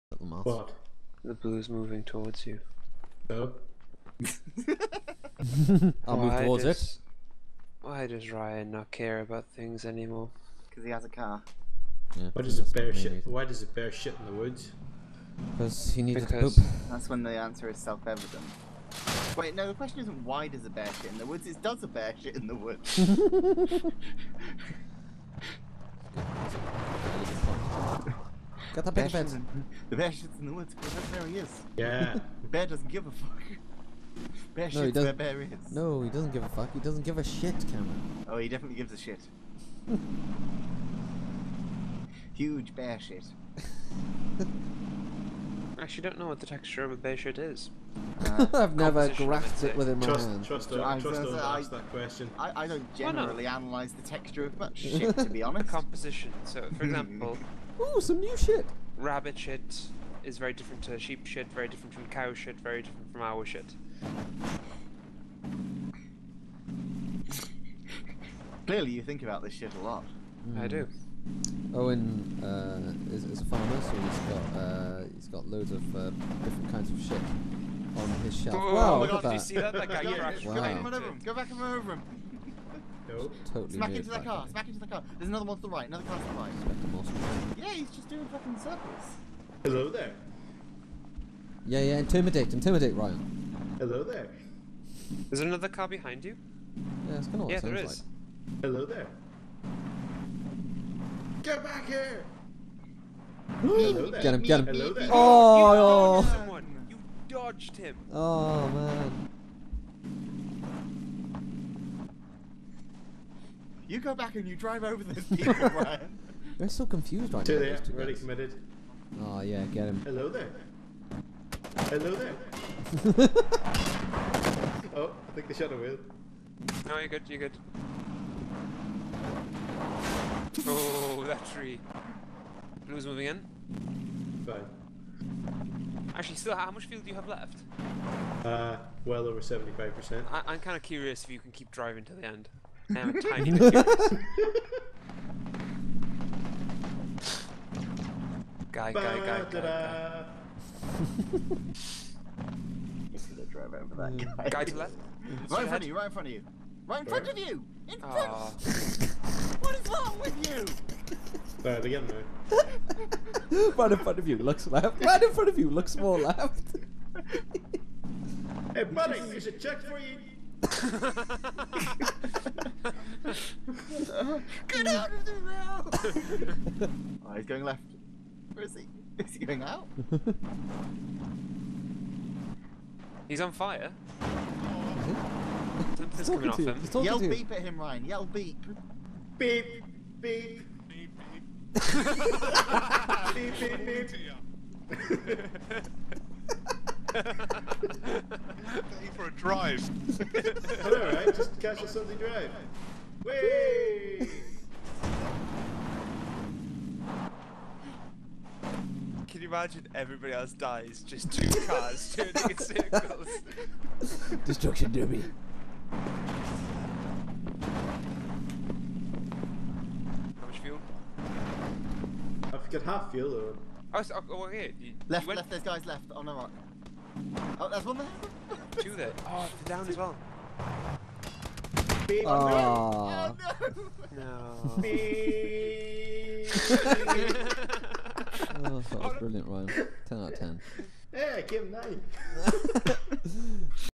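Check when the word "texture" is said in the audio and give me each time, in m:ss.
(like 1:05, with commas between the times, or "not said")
0:46, 0:54.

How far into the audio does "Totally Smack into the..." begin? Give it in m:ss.
1:23.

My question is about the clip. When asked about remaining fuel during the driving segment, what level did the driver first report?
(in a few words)
Well over 75%.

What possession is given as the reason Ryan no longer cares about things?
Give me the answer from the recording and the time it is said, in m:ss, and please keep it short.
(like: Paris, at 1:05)
A car, at 0:10.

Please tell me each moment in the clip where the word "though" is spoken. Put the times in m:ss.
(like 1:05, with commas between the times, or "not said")
2:42, 3:43.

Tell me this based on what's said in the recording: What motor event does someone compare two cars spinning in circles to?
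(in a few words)
Destruction derby.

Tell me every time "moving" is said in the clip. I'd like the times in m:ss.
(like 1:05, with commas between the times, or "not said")
0:01, 2:13.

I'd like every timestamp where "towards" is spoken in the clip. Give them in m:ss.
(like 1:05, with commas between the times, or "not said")
0:02, 0:06.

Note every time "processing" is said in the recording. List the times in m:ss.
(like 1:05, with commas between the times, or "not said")
not said.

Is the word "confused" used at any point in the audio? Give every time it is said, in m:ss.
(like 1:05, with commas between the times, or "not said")
1:56.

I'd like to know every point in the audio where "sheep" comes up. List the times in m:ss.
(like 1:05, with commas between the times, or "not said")
1:00.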